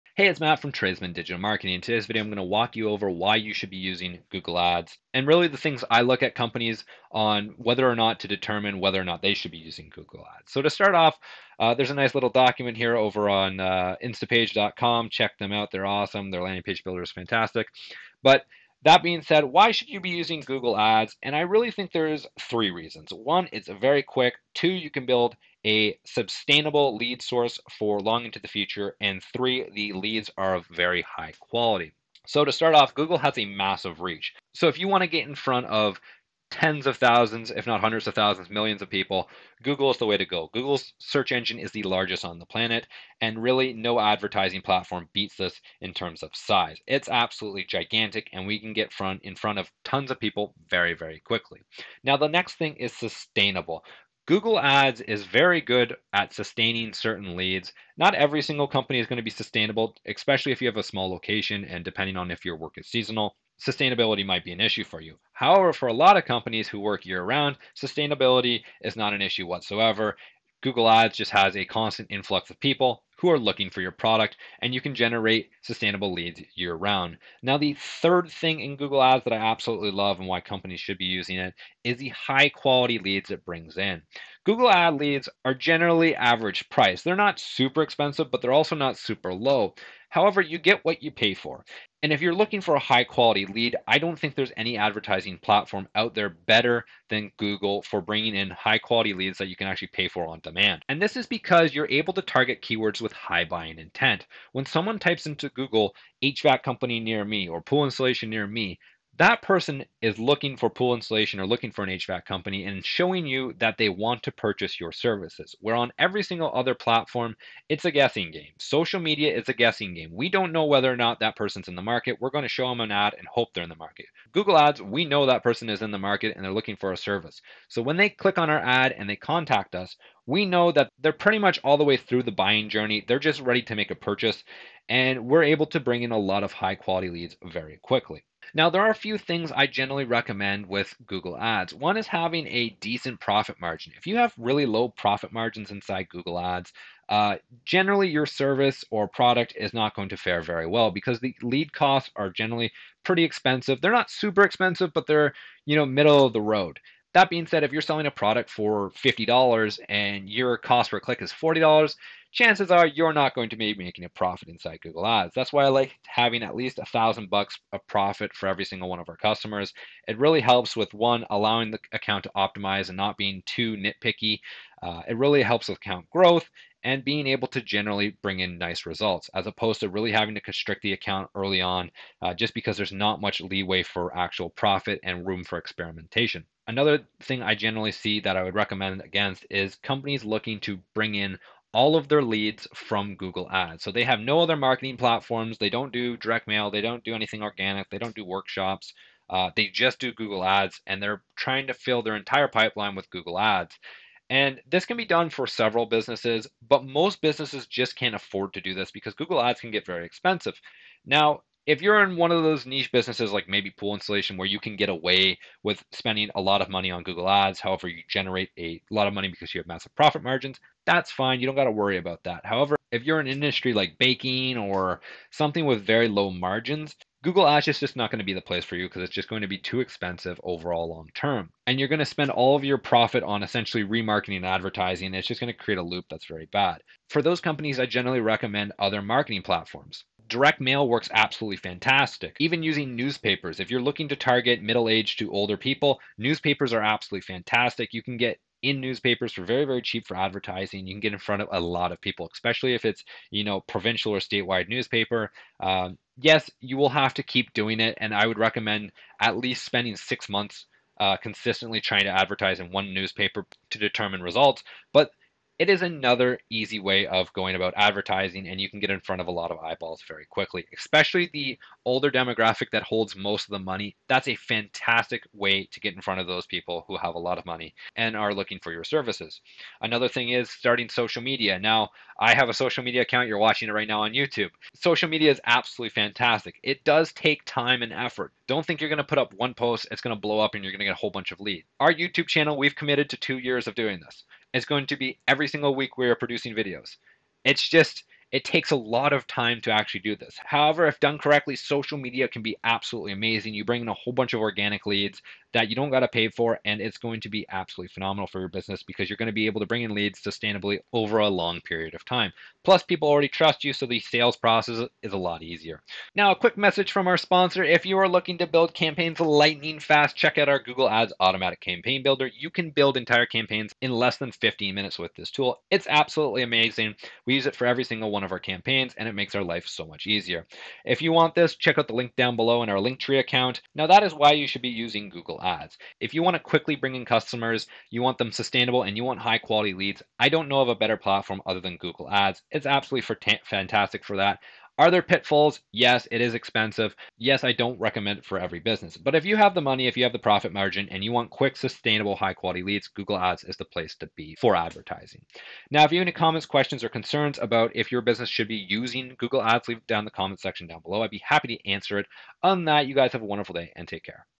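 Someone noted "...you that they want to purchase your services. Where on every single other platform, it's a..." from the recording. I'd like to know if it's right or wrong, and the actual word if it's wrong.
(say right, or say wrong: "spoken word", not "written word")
right.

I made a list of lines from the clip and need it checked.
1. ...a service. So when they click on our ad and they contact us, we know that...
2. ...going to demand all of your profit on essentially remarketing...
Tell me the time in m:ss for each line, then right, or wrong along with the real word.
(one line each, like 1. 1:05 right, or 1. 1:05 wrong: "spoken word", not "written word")
1. 2:06 right
2. 3:51 wrong: "spend", not "demand".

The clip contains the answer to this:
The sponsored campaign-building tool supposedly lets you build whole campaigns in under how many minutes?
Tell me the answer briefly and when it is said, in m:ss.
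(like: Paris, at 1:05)
15, at 5:24.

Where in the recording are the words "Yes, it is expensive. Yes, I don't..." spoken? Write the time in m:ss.
5:45.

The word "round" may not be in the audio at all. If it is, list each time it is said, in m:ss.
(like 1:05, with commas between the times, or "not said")
1:07, 1:16.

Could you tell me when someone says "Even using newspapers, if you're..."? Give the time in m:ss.
4:02.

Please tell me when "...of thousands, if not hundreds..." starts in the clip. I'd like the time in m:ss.
0:36.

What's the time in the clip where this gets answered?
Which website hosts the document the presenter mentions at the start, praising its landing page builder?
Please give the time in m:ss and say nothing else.
0:14.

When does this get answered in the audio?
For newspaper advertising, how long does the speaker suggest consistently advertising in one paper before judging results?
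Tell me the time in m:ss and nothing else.
4:19.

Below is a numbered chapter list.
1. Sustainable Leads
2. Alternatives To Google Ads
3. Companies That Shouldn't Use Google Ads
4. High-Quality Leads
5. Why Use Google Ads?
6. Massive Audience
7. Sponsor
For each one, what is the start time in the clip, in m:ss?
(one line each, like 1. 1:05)
1. 0:52
2. 3:57
3. 2:17
4. 1:20
5. 0:19
6. 0:34
7. 5:15.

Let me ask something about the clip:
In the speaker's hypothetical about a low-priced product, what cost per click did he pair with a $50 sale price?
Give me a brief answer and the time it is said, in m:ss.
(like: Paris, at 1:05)
$40, at 2:41.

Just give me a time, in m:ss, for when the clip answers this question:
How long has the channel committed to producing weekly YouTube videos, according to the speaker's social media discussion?
4:53.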